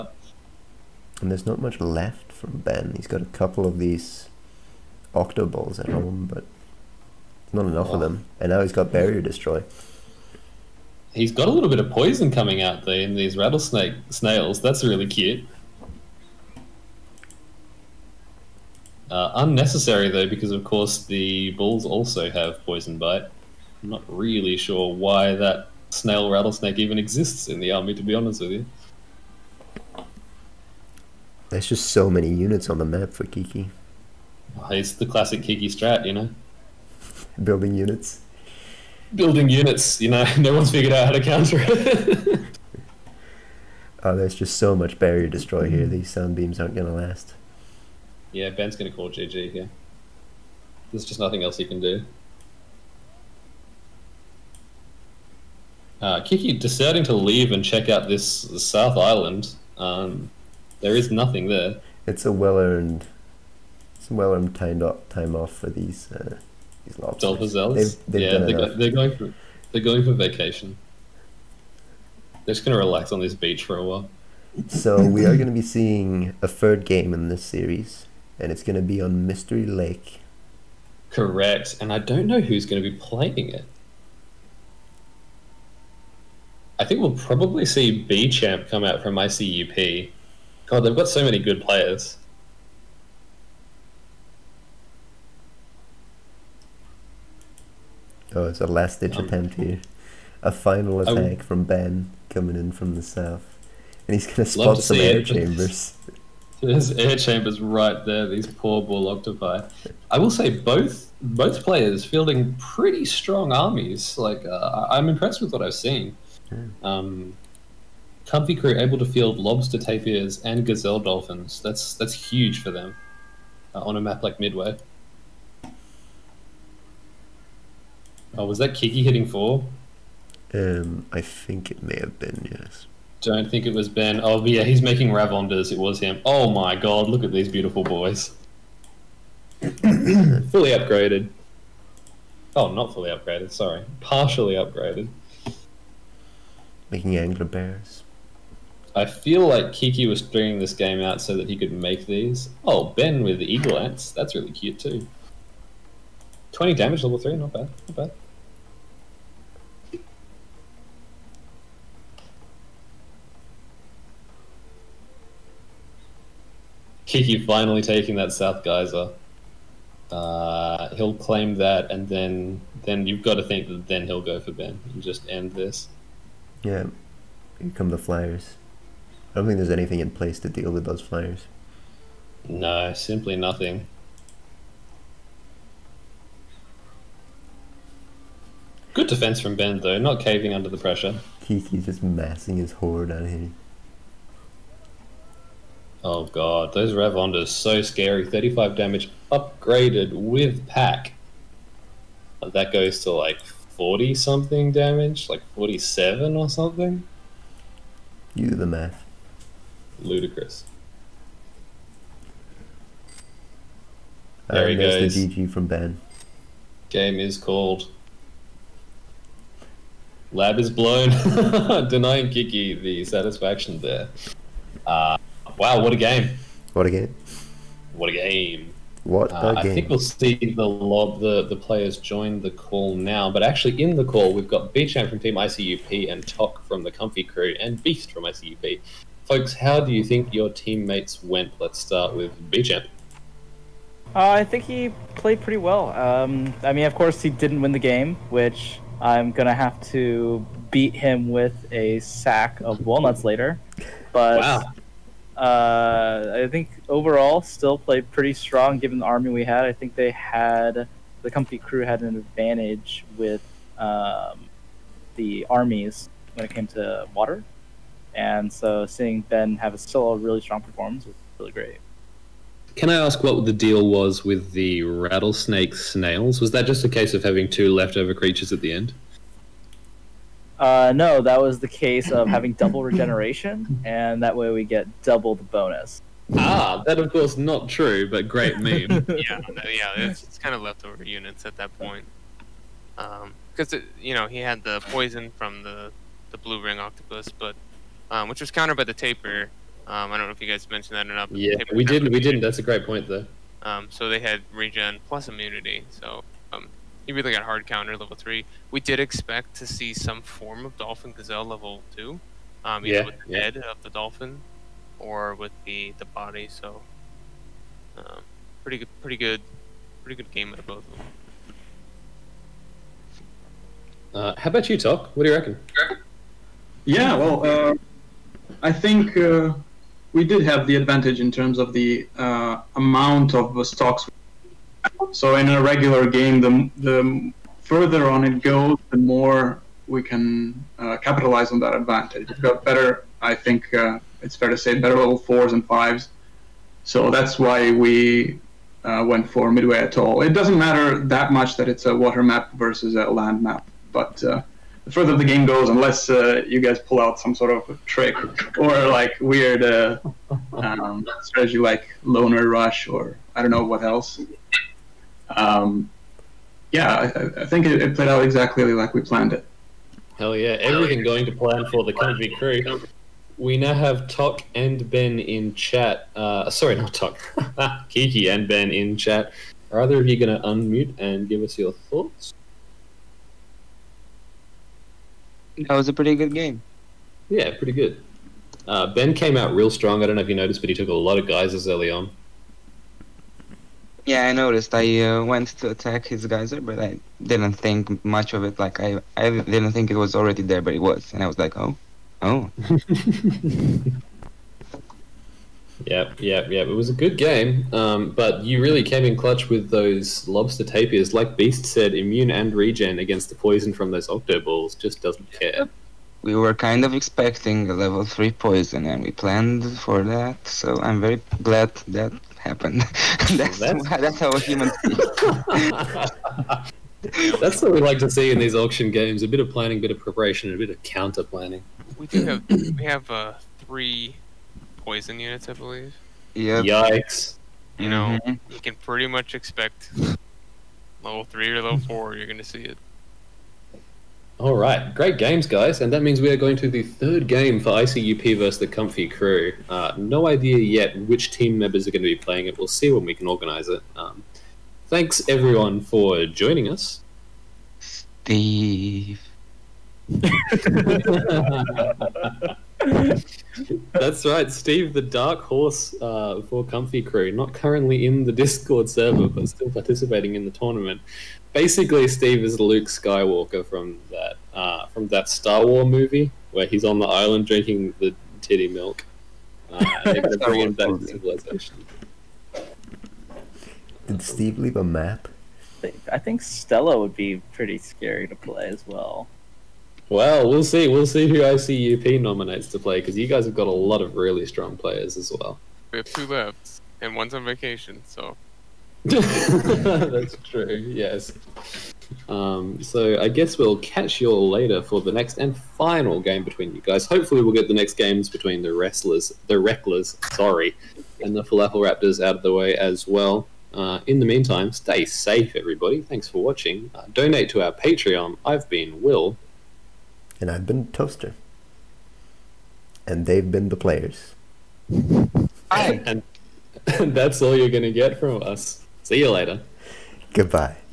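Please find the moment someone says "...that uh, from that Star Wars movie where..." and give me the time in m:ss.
7:54.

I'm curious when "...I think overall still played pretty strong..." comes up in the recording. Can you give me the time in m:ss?
4:16.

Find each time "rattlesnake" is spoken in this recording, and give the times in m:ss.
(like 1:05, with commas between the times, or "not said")
0:13, 0:26, 4:34.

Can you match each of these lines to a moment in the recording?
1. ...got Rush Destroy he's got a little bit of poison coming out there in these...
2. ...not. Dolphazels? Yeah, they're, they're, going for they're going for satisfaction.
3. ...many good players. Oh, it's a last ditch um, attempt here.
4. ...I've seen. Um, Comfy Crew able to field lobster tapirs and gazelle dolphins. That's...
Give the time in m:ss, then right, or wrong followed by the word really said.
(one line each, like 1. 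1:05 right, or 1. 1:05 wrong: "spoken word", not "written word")
1. 0:08 wrong: "Barrier", not "Rush"
2. 1:06 wrong: "vacation", not "satisfaction"
3. 1:31 right
4. 1:55 right.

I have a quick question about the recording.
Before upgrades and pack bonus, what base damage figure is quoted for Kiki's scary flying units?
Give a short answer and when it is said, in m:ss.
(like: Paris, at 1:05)
35, at 3:18.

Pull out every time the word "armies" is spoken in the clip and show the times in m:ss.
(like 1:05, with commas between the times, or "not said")
1:53, 4:25.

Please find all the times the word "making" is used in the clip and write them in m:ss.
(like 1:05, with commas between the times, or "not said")
2:14, 2:26.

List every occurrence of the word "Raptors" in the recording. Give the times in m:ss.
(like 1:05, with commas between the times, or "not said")
8:31.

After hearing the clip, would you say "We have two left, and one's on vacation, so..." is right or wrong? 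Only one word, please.
right.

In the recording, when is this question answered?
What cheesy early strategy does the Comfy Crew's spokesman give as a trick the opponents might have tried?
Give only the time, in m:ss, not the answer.
6:02.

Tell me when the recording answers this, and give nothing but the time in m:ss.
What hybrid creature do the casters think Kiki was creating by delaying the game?
2:27.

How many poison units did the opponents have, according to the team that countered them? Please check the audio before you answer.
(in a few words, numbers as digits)
3.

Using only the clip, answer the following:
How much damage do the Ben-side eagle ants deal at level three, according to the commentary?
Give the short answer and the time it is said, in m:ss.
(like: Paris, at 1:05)
20, at 2:36.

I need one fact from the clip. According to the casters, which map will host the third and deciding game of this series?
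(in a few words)
Mystery Lake.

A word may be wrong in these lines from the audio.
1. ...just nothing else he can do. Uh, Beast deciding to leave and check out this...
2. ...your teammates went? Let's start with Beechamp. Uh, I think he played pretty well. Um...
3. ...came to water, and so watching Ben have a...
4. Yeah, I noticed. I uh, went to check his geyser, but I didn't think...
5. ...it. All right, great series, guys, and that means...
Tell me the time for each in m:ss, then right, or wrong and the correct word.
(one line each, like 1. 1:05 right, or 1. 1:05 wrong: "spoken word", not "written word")
1. 0:51 wrong: "Kiki", not "Beast"
2. 4:00 right
3. 4:26 wrong: "seeing", not "watching"
4. 6:34 wrong: "attack", not "check"
5. 7:22 wrong: "games", not "series".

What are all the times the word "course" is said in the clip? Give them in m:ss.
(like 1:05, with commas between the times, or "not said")
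0:20, 4:06, 4:47.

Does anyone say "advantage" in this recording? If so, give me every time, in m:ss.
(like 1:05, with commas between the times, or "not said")
4:22, 5:30, 5:41.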